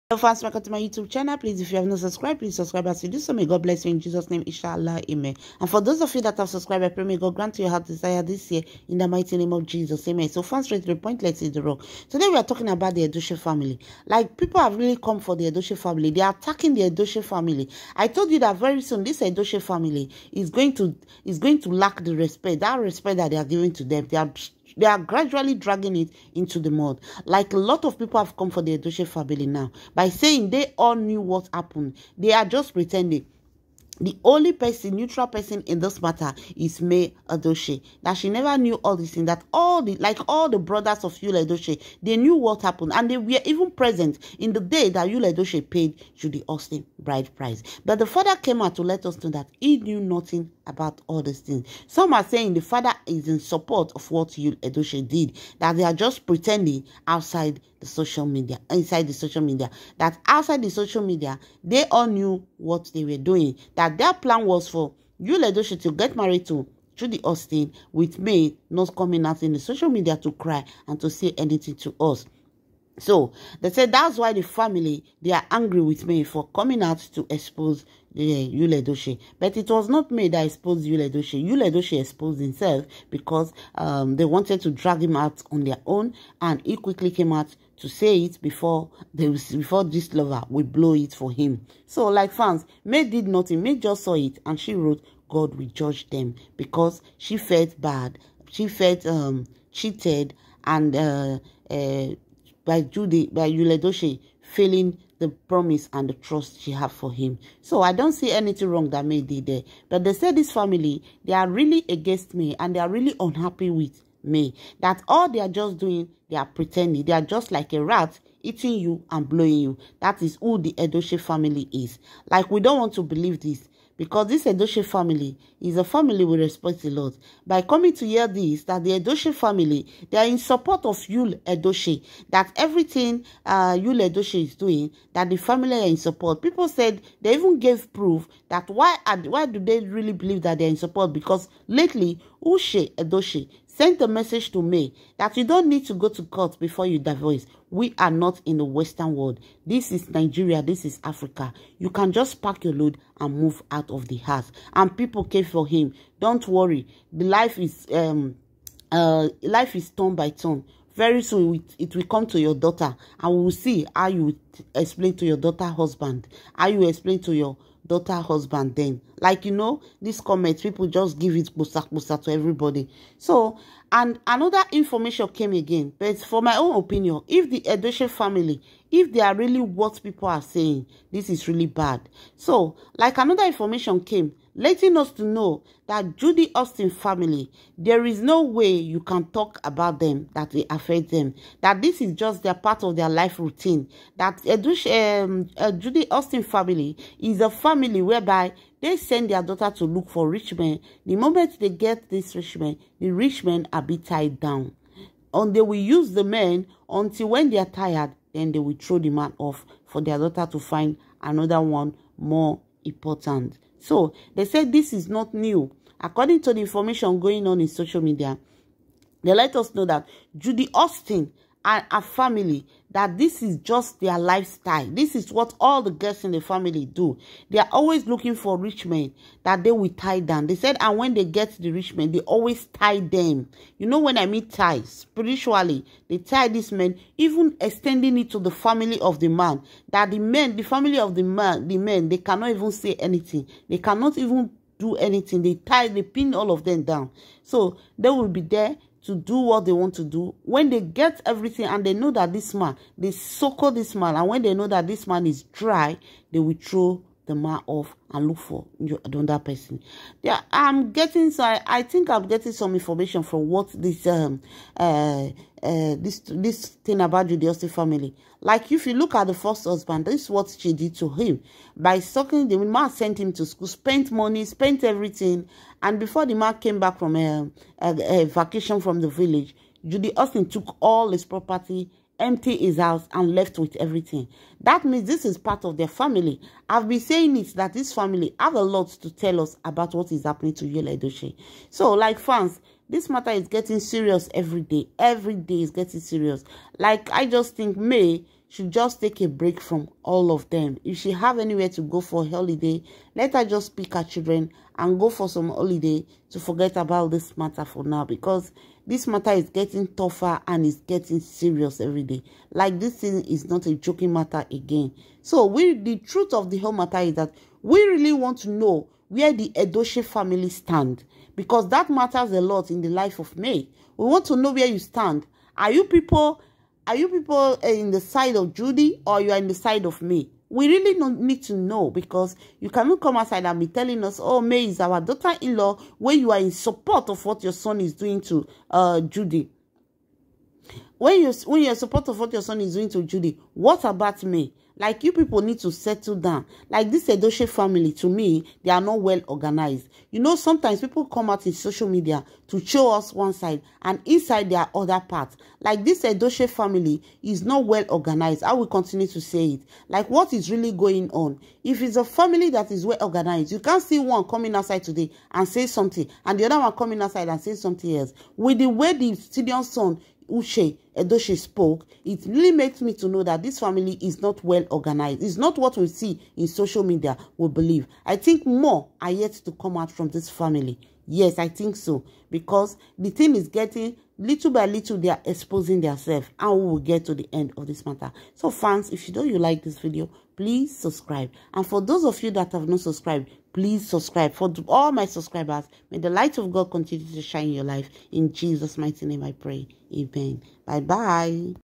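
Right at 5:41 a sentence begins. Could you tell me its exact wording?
when you when you're supportive of what your son is doing to Judy, what about me?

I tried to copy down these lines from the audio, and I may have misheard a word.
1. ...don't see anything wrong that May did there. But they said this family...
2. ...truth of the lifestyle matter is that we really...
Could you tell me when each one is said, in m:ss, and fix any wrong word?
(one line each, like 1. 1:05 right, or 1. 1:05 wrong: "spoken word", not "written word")
1. 1:47 right
2. 5:15 wrong: "whole", not "lifestyle".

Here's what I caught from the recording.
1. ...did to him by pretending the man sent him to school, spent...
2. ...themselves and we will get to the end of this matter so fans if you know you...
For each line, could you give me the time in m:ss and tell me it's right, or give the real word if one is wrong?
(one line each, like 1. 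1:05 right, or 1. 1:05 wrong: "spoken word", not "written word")
1. 4:30 wrong: "sucking", not "pretending"
2. 6:25 right.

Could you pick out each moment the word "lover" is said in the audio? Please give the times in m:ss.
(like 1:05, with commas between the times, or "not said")
1:30.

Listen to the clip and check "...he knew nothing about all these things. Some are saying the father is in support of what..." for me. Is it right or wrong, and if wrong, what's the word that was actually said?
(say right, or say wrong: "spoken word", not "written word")
right.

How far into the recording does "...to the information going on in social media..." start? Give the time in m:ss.
3:36.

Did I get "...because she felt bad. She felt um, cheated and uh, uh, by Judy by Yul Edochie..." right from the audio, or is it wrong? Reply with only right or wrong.
right.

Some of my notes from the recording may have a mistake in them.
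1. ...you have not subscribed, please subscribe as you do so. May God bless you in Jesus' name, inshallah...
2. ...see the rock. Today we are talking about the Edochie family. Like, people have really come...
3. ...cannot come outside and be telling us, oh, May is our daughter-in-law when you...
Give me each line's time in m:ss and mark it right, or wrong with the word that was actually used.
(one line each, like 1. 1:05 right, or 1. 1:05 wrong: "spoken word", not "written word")
1. 0:01 right
2. 0:11 right
3. 5:32 right.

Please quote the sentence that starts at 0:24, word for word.
They are they are gradually dragging it into the mud.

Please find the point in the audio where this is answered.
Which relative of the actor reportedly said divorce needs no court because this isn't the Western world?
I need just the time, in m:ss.
2:22.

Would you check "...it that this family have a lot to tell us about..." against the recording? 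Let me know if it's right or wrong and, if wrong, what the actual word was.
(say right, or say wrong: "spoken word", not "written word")
right.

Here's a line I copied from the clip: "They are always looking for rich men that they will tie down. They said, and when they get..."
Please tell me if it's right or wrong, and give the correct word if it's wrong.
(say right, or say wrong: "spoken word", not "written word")
right.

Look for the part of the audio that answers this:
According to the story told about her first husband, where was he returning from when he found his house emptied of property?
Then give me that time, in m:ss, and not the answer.
4:39.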